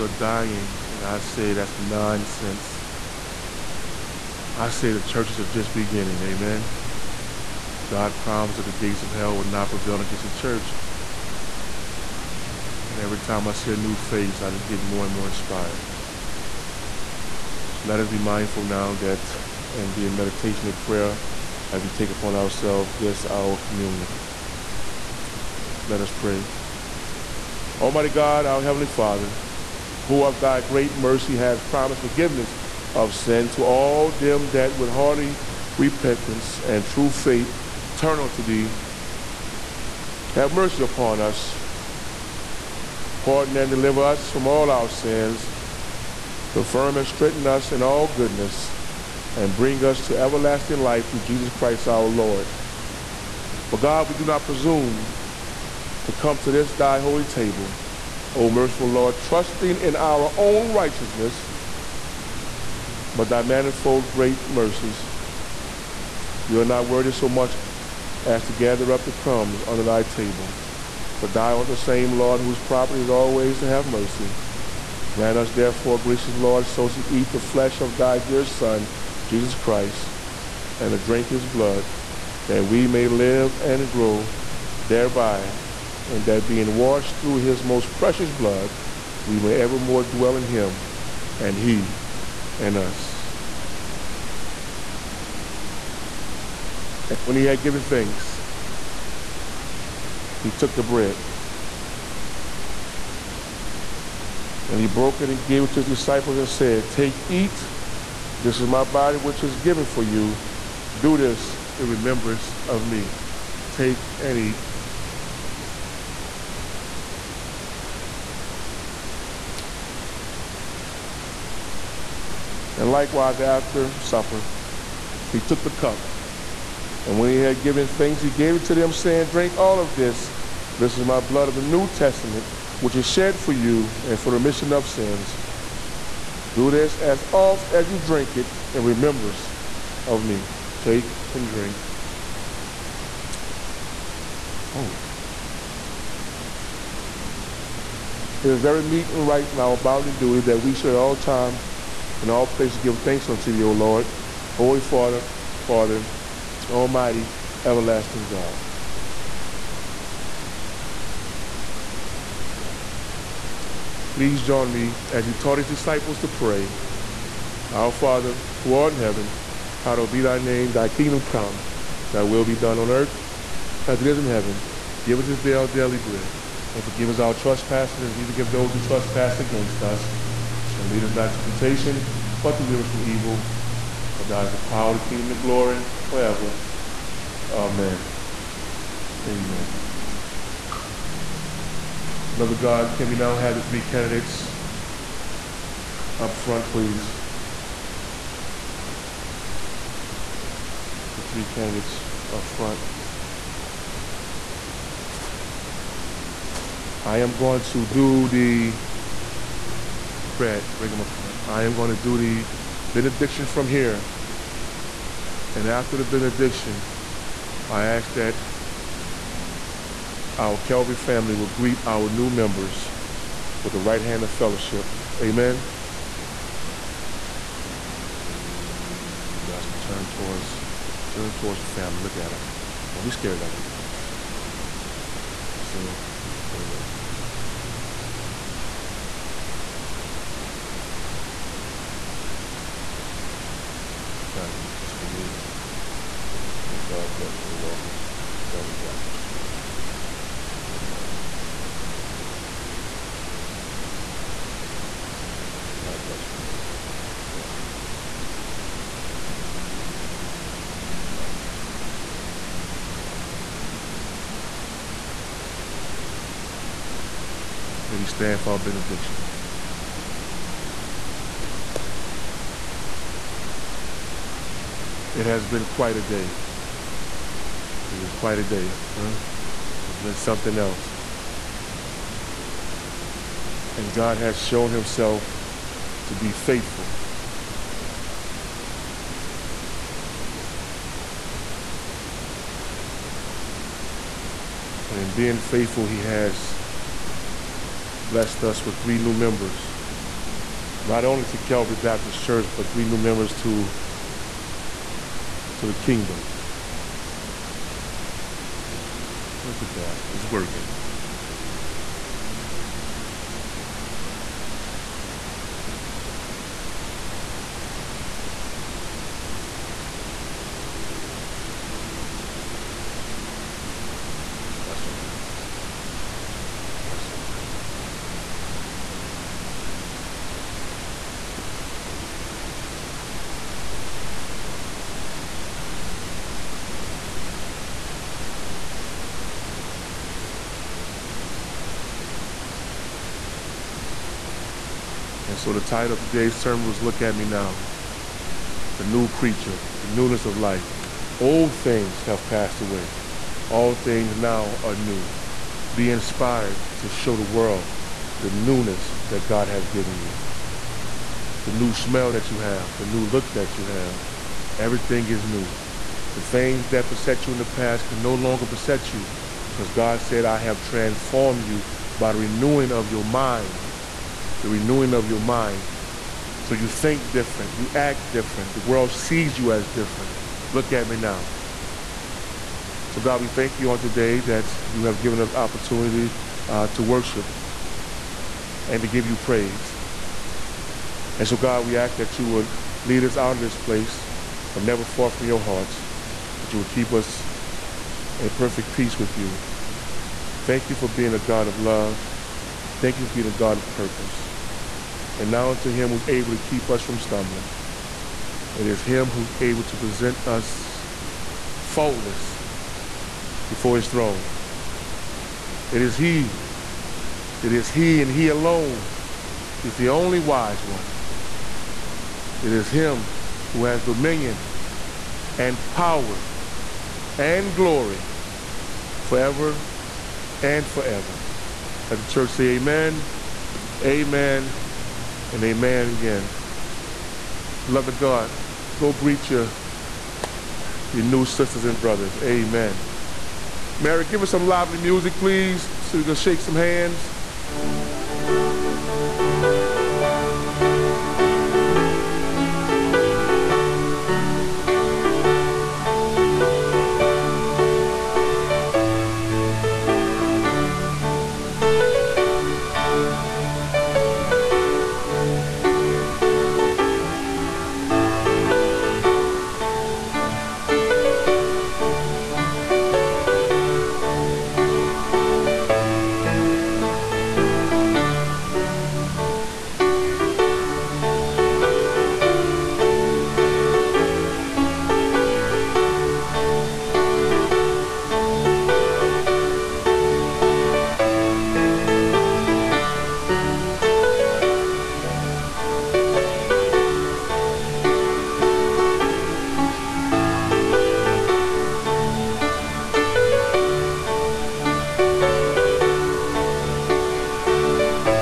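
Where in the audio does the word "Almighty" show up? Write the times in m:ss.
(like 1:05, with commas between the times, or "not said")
0:27, 2:36.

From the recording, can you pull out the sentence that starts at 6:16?
So you think different, you act different, the world sees you as different.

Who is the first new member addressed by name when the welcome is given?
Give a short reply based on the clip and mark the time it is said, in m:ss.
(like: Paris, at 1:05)
Connie, at 4:04.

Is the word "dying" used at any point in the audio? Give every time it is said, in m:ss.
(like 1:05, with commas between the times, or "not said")
0:00.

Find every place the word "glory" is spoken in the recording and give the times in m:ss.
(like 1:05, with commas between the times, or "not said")
3:05, 7:07.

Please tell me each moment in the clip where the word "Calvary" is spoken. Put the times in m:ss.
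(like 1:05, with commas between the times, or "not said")
3:40, 4:08, 5:01.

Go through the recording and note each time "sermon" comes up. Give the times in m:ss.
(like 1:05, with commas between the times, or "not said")
5:46.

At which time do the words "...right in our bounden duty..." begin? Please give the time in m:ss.
2:29.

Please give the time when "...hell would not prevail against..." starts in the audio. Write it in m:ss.
0:09.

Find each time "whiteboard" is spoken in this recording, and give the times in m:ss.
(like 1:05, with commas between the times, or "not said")
not said.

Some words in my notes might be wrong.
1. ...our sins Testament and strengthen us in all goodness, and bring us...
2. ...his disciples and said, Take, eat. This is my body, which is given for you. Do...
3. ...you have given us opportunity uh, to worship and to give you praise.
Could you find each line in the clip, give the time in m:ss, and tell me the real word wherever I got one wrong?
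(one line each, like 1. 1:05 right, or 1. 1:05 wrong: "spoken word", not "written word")
1. 0:44 wrong: "Confirm", not "Testament"
2. 1:45 right
3. 6:24 right.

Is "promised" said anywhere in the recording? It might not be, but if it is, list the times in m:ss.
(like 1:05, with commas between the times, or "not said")
0:08, 0:31.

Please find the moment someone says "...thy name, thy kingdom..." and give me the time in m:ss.
2:50.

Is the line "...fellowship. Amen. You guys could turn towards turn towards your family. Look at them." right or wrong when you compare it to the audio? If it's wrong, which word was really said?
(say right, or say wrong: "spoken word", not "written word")
right.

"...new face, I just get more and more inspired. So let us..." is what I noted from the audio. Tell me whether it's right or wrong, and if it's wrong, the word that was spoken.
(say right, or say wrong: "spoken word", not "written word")
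right.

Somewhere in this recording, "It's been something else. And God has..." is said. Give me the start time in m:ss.
4:39.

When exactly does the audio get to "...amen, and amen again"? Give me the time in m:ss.
7:13.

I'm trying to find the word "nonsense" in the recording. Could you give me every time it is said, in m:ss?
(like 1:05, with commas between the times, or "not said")
0:01.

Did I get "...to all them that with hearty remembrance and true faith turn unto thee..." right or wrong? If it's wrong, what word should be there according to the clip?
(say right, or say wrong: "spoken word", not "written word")
wrong: "repentance", not "remembrance".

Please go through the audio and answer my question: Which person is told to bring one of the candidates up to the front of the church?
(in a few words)
Fred.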